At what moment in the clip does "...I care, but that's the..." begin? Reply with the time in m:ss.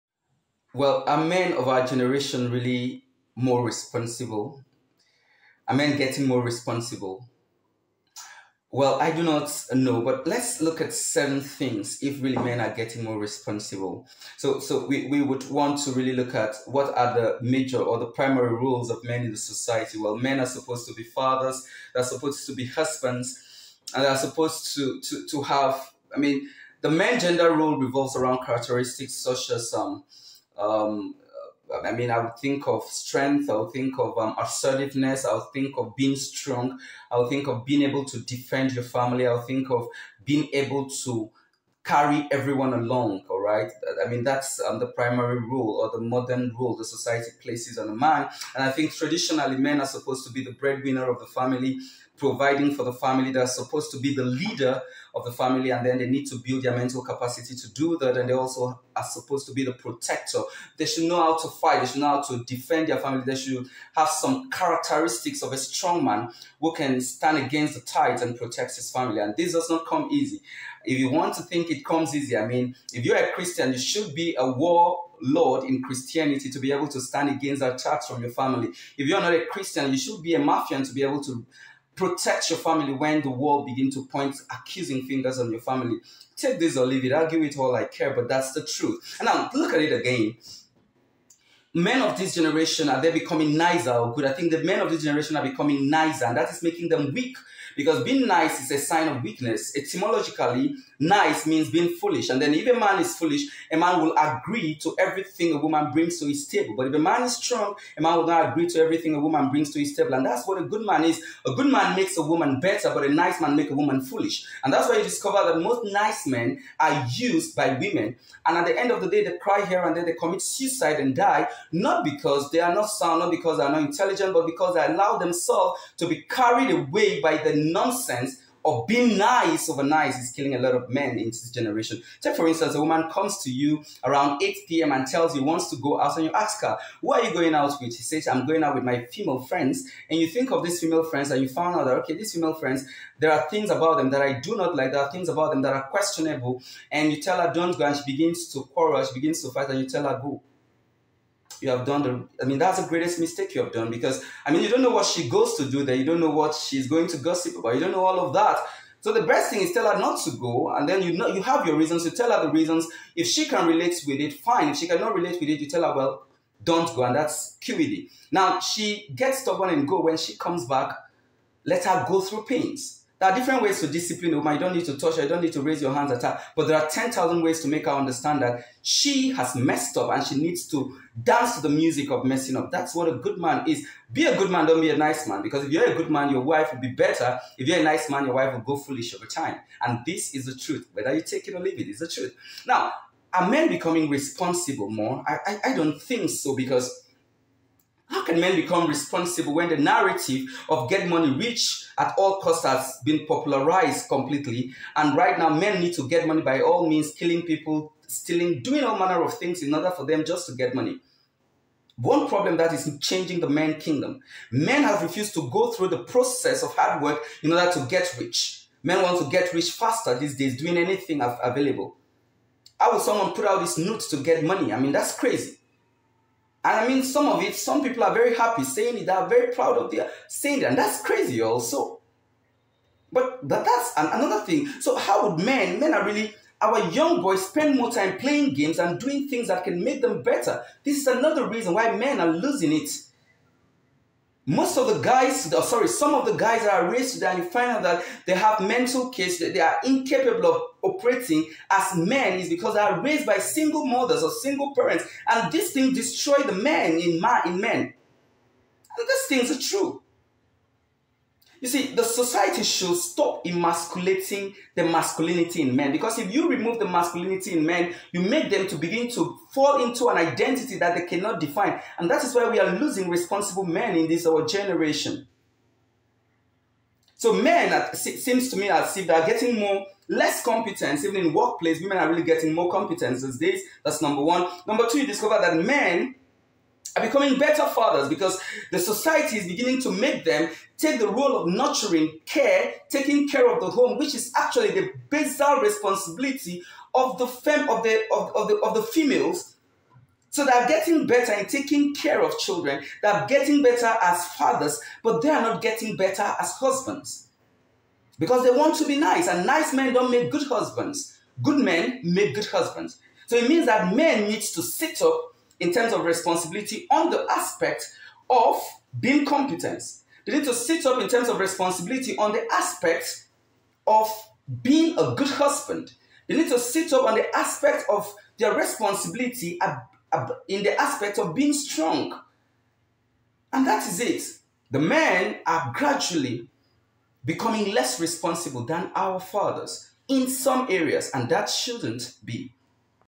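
1:27.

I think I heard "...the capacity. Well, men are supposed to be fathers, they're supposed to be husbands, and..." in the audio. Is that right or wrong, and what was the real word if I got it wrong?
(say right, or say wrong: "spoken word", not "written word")
wrong: "society", not "capacity".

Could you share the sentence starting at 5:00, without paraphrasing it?
So they're getting better in taking care of children, they're getting better as fathers, but they are not getting better as husbands.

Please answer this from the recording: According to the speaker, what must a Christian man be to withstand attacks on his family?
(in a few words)
A war Lord.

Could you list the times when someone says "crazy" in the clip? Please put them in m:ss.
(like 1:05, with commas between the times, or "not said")
3:45, 3:51.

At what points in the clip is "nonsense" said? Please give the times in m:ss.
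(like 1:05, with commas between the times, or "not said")
2:07.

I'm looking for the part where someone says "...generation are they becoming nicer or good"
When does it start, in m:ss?
1:32.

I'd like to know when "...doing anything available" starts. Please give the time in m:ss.
3:40.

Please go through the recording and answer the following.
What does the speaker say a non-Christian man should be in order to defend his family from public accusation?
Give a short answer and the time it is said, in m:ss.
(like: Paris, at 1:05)
A mafia, at 1:20.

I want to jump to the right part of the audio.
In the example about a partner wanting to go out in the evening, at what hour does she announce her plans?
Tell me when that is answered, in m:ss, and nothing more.
2:14.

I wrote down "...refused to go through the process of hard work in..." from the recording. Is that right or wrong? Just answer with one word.
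right.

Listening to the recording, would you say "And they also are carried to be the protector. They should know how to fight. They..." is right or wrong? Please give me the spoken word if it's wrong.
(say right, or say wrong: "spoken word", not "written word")
wrong: "supposed", not "carried".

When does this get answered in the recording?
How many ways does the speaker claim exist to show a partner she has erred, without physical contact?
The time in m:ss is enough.
2:56.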